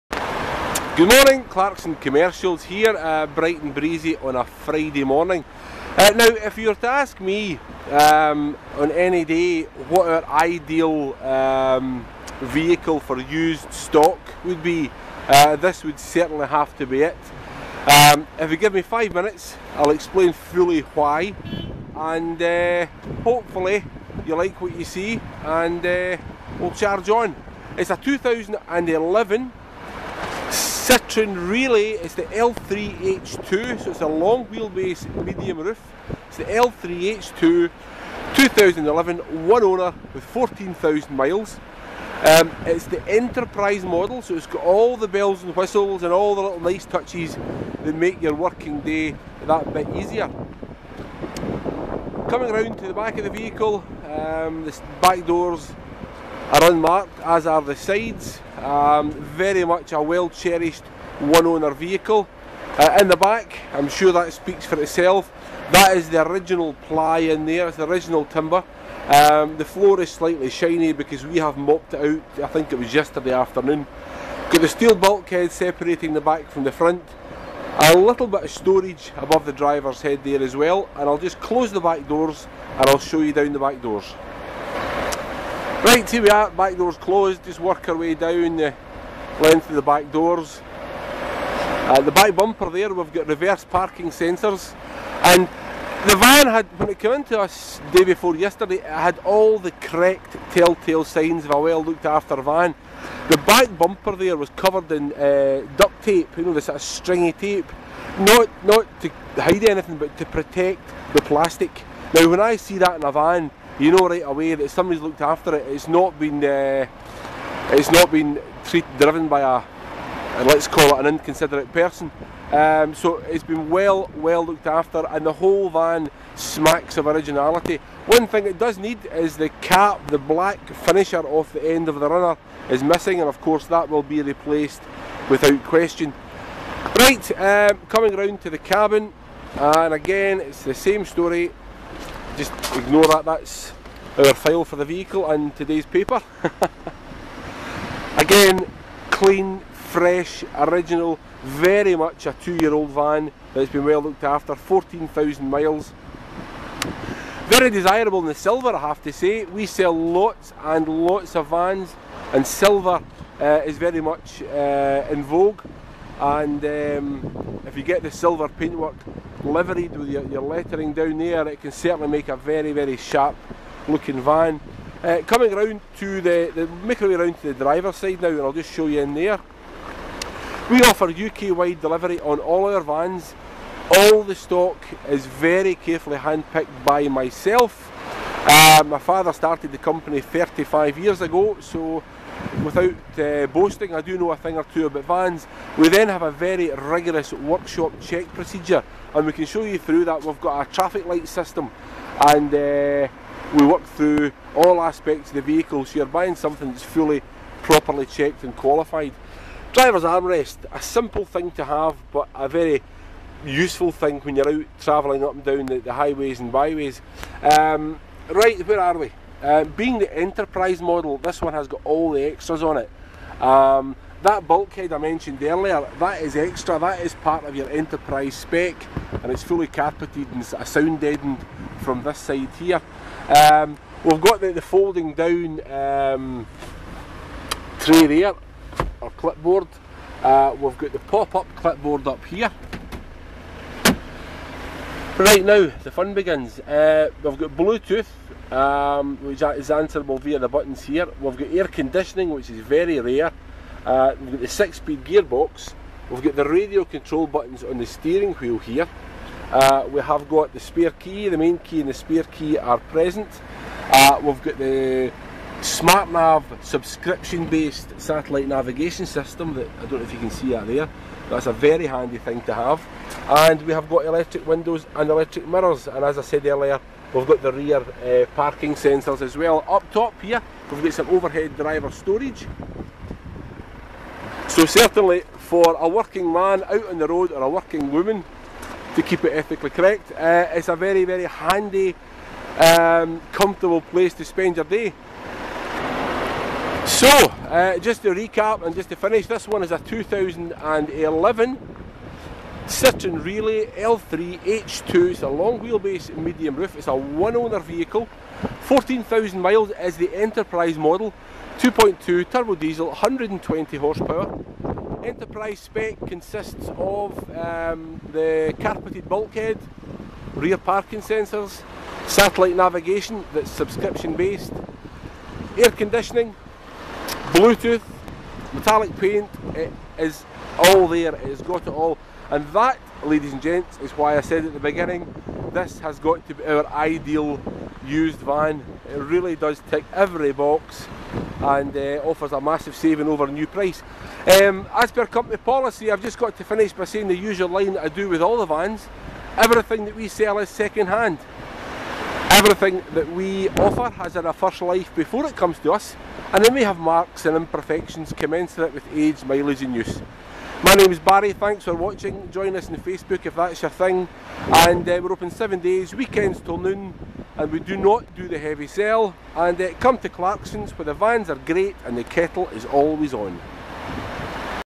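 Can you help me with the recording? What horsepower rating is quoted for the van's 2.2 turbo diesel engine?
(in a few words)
120.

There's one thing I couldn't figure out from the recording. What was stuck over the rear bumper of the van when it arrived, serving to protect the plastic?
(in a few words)
Duct tape.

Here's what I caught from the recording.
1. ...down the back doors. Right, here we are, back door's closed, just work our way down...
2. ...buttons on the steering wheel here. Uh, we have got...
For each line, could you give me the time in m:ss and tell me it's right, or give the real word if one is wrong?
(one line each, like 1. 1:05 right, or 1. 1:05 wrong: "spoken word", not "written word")
1. 1:23 right
2. 4:17 right.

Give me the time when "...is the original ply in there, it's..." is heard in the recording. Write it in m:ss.
1:05.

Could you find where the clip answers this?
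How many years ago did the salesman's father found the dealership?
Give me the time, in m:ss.
3:10.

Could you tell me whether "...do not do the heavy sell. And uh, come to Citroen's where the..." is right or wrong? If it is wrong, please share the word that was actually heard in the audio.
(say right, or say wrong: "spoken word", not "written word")
wrong: "Clarkson", not "Citroen".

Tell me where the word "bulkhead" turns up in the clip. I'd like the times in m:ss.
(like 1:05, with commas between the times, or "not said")
1:14, 3:44, 5:19.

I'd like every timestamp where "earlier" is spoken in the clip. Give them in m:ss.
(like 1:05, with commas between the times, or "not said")
3:45, 4:36.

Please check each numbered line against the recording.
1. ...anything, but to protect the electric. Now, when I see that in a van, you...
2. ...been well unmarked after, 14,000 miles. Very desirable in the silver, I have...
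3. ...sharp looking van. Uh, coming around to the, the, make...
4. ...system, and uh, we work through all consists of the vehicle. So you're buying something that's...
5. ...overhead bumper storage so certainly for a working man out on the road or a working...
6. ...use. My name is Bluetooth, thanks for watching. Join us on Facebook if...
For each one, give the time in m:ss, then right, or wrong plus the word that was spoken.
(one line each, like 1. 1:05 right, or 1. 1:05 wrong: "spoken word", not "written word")
1. 1:49 wrong: "plastic", not "electric"
2. 2:33 wrong: "looked", not "unmarked"
3. 2:52 right
4. 3:21 wrong: "aspects", not "consists"
5. 4:41 wrong: "driver", not "bumper"
6. 5:59 wrong: "Barry", not "Bluetooth".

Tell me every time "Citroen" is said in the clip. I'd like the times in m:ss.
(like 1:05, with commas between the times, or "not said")
0:30, 5:02.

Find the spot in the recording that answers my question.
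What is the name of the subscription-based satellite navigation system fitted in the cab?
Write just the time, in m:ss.
4:25.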